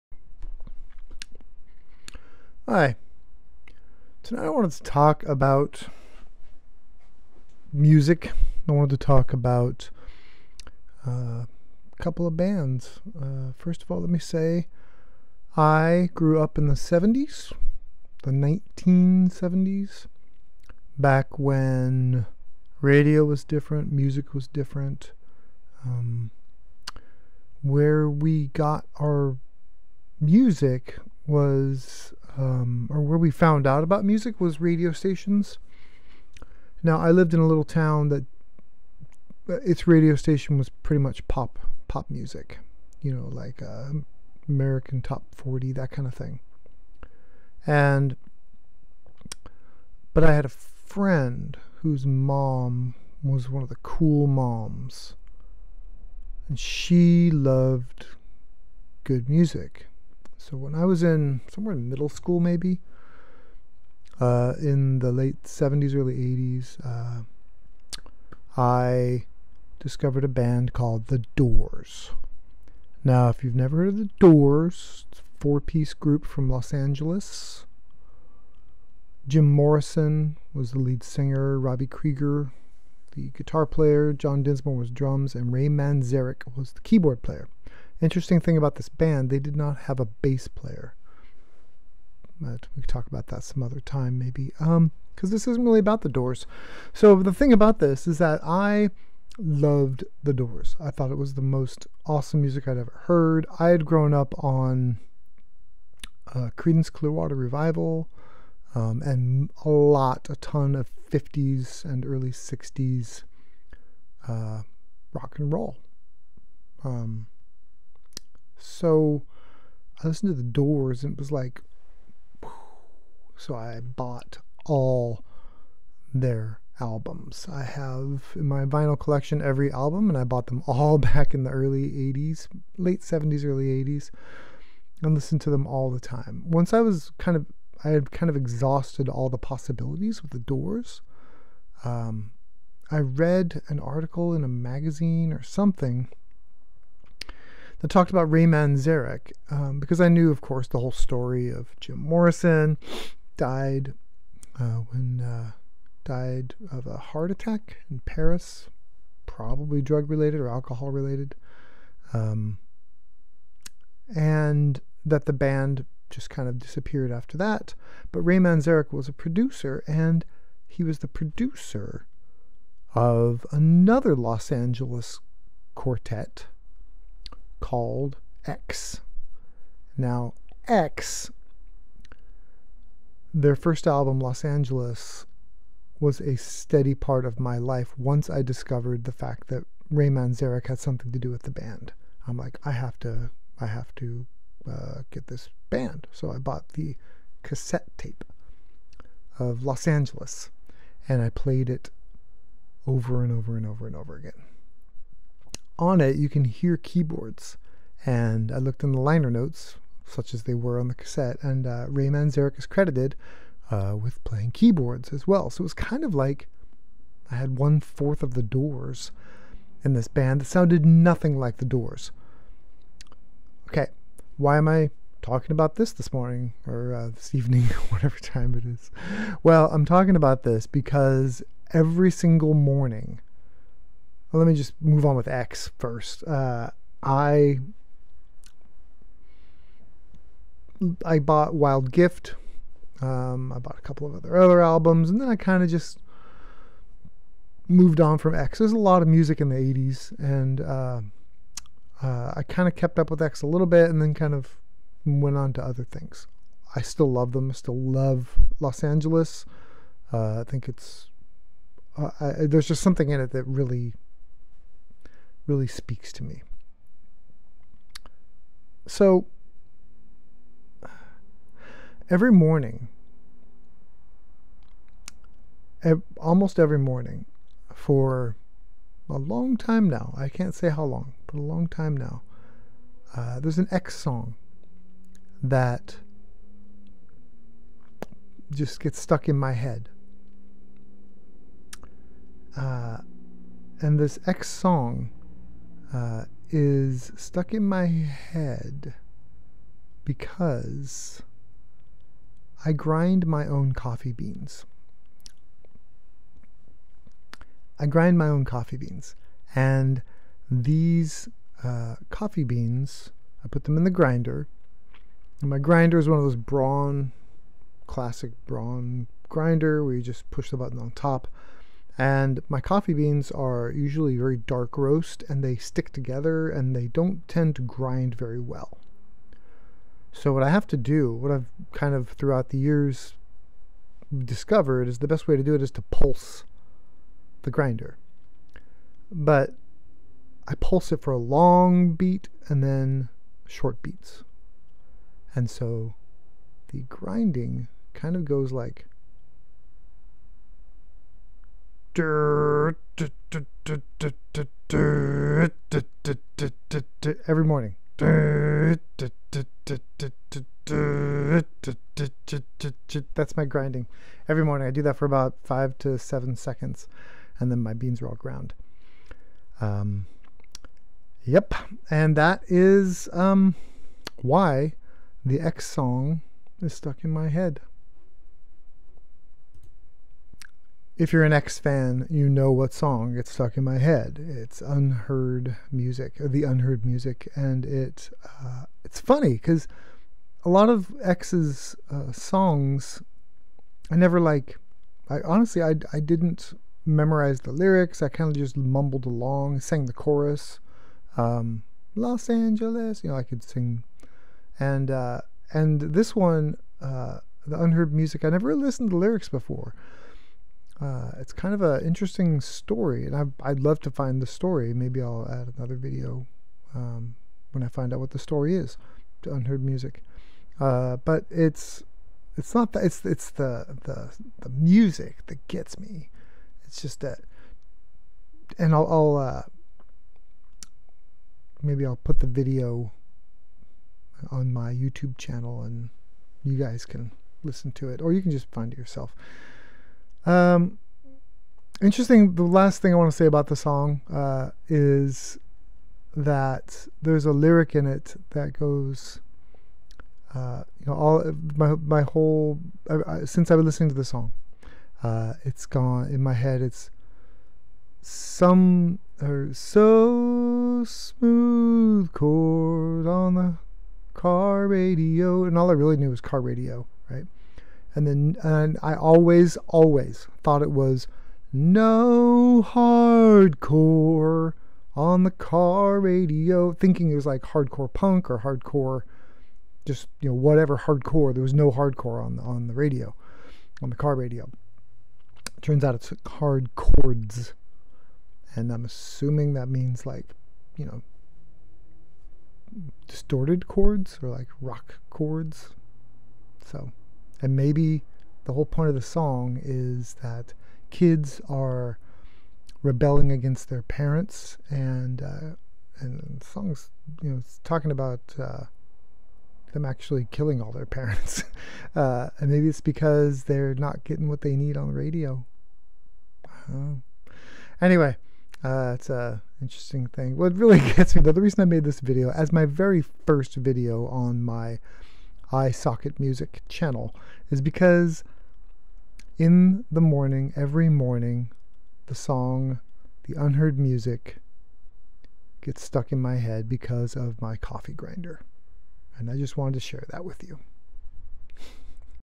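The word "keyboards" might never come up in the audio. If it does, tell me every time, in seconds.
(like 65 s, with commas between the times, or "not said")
86 s, 206 s, 214 s.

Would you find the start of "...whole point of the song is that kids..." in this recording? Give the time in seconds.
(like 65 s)
498 s.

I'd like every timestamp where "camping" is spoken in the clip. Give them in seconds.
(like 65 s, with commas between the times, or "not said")
not said.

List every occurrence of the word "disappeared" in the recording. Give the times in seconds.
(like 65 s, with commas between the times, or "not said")
166 s.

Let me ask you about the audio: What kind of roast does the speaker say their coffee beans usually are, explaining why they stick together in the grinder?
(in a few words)
Very dark roast.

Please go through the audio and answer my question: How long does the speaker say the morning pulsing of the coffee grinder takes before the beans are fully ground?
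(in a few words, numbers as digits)
5 to 7 seconds.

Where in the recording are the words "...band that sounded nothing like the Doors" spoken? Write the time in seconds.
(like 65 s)
220 s.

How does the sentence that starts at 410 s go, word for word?
Uh, it's kind of an interesting story, and I, would love to find the story.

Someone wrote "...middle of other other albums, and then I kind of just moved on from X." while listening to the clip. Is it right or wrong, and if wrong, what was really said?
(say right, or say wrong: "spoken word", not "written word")
wrong: "couple", not "middle".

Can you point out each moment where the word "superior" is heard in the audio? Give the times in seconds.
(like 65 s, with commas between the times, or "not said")
not said.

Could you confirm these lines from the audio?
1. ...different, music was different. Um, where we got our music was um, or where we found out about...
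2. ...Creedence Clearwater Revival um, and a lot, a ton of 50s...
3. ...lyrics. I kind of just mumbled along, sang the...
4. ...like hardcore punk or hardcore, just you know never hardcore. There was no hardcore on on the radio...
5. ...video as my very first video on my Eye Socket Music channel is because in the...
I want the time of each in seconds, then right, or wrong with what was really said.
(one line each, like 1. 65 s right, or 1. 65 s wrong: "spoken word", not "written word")
1. 23 s right
2. 106 s right
3. 397 s right
4. 477 s wrong: "whatever", not "never"
5. 522 s right.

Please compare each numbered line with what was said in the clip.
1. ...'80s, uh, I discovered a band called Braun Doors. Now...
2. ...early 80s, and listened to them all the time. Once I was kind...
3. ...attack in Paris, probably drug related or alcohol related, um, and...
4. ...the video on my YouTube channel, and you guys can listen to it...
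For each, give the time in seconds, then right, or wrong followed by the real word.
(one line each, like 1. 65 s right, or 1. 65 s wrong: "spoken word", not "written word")
1. 66 s wrong: "The", not "Braun"
2. 133 s right
3. 157 s right
4. 432 s right.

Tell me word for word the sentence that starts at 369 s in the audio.
Um, yep, and that is um, why the X song is stuck in my head.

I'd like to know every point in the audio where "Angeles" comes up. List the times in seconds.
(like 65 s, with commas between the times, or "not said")
76 s, 174 s, 184 s, 199 s, 258 s, 402 s.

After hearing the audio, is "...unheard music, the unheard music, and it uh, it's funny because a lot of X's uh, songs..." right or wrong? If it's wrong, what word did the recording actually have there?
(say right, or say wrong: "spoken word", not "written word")
right.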